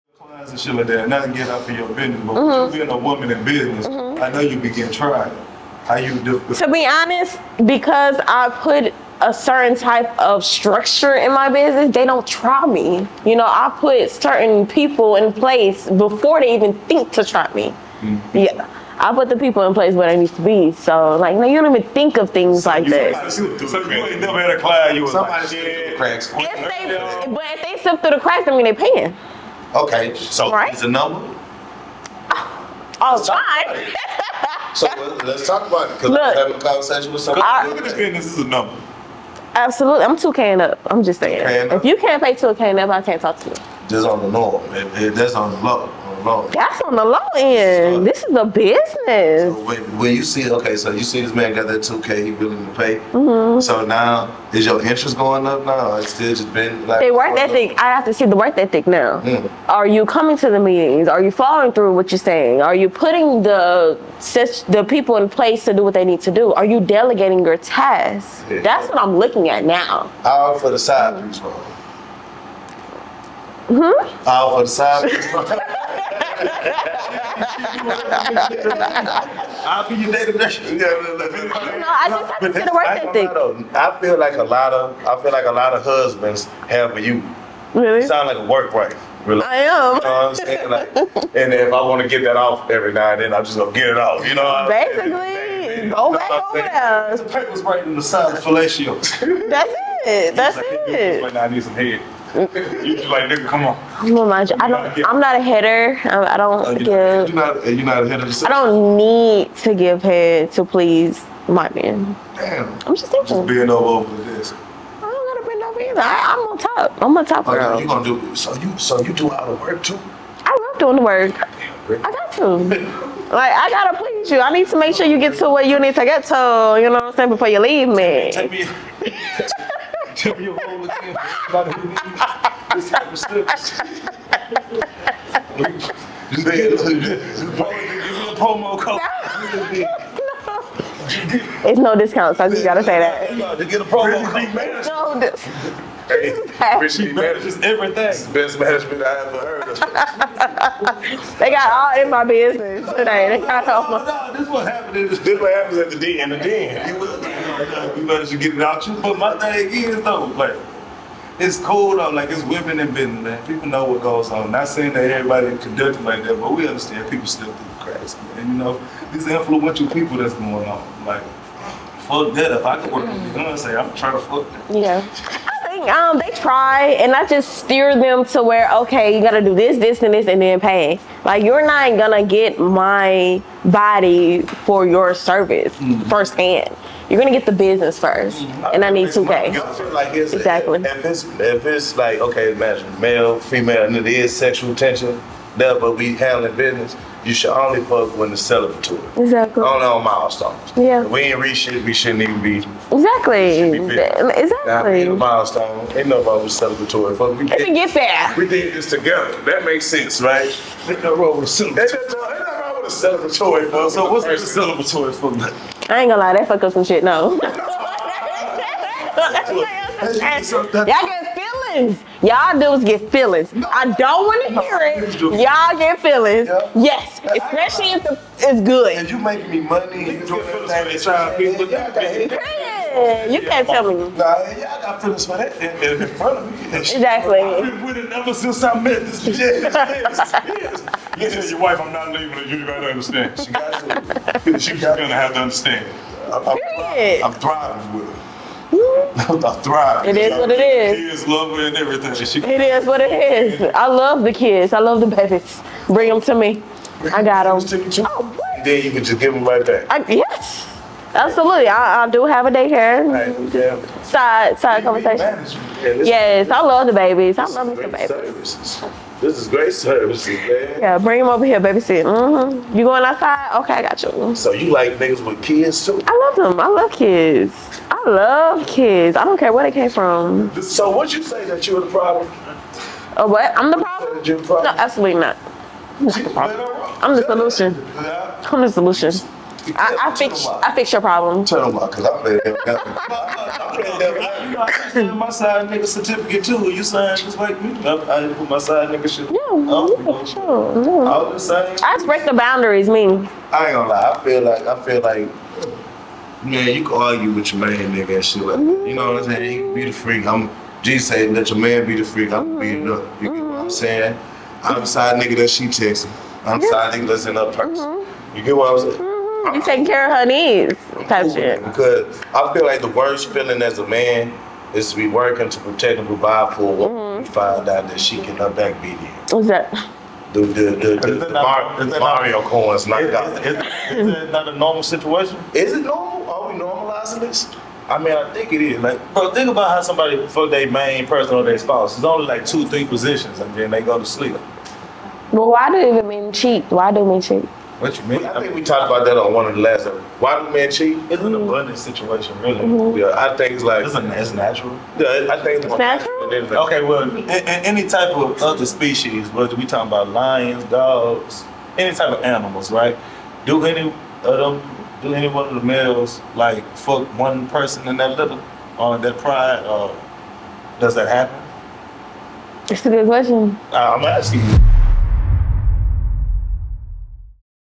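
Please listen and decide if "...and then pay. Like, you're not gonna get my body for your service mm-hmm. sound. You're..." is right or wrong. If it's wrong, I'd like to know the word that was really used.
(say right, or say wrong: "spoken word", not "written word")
wrong: "firsthand", not "sound".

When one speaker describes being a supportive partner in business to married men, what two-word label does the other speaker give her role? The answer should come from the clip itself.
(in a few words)
work wife.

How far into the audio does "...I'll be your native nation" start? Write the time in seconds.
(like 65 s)
79 s.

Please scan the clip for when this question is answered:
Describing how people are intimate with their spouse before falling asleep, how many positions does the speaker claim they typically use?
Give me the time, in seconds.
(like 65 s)
342 s.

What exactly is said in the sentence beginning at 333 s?
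Is, is, is it not a normal situation?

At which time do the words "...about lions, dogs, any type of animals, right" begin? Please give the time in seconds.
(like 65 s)
359 s.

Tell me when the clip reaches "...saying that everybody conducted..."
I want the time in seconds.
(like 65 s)
164 s.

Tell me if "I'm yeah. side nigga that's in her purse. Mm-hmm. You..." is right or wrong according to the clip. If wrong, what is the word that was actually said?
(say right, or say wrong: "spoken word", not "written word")
right.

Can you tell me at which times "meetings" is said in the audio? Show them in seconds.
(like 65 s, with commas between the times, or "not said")
60 s.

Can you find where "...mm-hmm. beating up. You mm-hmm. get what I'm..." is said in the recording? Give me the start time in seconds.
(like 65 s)
312 s.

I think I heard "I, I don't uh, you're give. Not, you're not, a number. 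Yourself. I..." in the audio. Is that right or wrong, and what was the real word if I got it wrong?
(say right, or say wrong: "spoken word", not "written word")
wrong: "hitter", not "number".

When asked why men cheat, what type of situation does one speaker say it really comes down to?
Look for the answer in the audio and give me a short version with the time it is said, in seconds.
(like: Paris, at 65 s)
abundance situation, at 351 s.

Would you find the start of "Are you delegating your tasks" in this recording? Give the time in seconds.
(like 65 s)
66 s.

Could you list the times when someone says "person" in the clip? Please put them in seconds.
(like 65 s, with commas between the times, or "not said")
341 s, 367 s.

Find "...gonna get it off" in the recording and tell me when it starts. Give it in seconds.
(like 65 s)
93 s.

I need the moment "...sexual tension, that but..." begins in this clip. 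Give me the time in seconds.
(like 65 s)
194 s.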